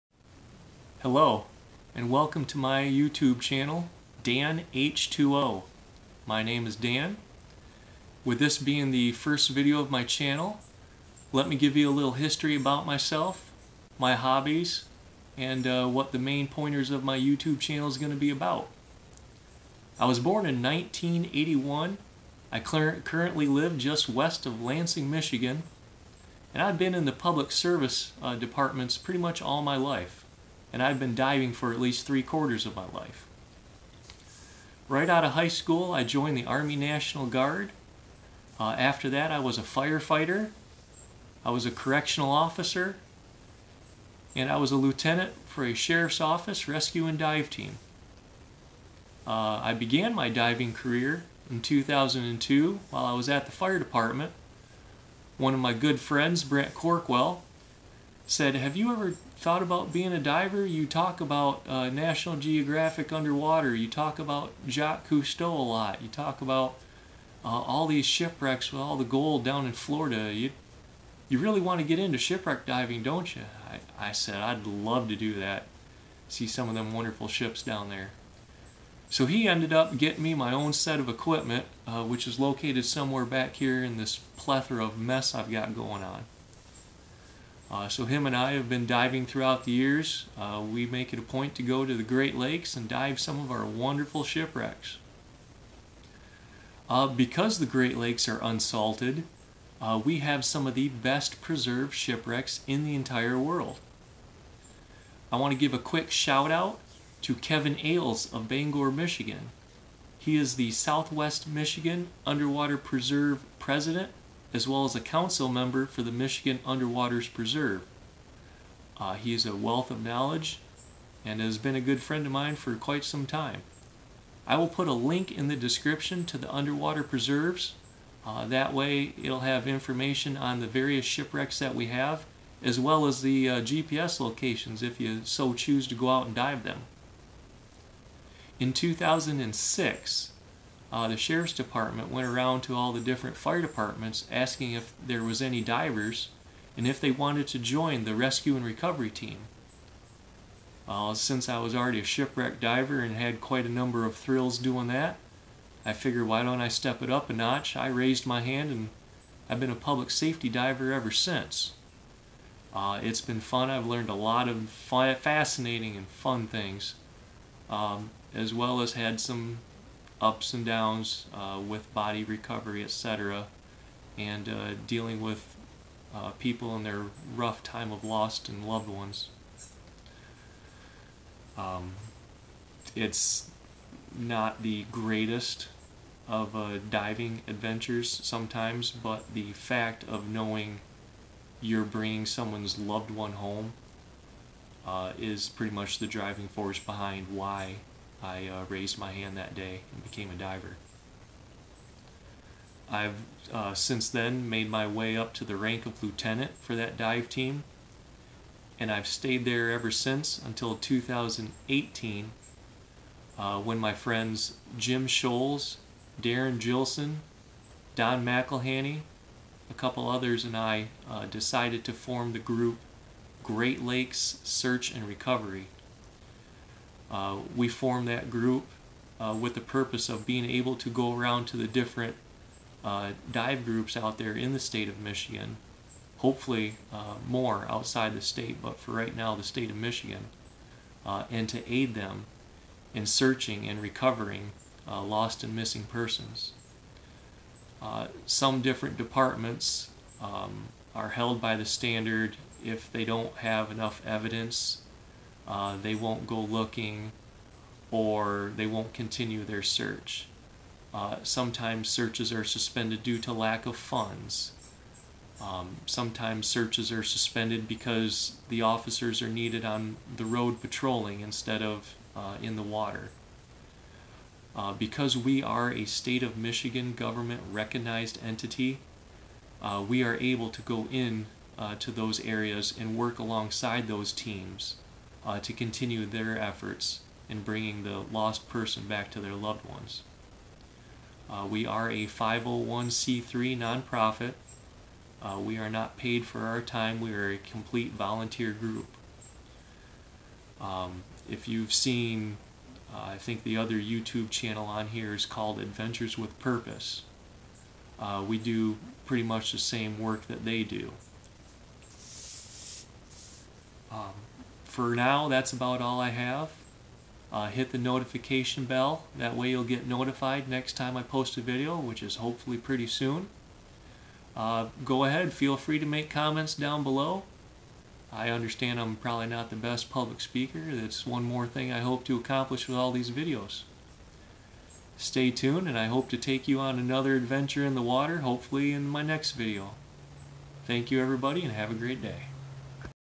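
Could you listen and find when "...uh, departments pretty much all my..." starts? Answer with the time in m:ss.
0:28.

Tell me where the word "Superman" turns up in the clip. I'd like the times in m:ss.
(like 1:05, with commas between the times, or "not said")
not said.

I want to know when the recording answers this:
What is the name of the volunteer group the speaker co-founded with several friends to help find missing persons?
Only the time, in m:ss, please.
3:43.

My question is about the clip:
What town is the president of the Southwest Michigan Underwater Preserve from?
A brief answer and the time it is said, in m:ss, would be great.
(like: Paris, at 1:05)
Bangor, Michigan, at 1:48.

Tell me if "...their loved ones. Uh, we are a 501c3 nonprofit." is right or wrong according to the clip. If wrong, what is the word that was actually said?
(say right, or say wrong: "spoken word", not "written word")
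right.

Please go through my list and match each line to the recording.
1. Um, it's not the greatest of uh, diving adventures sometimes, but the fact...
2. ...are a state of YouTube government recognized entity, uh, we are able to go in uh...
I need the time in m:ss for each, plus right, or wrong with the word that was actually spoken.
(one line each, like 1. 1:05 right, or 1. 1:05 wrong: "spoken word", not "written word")
1. 3:01 right
2. 4:35 wrong: "Michigan", not "YouTube".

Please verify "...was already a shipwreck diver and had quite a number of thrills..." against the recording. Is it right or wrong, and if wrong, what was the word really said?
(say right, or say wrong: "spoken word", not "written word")
right.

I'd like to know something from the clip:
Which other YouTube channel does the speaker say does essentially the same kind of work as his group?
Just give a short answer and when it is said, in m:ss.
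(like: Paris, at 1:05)
Adventures with Purpose, at 5:05.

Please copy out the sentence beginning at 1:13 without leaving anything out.
I, I said, I'd love to do that, see some of them wonderful ships down there.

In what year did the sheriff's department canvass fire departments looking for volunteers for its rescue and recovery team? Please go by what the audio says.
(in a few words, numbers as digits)
2006.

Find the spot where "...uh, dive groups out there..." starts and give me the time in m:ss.
3:52.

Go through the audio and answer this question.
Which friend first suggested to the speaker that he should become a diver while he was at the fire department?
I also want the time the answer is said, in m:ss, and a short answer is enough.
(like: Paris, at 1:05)
Brent Corkwell, at 0:56.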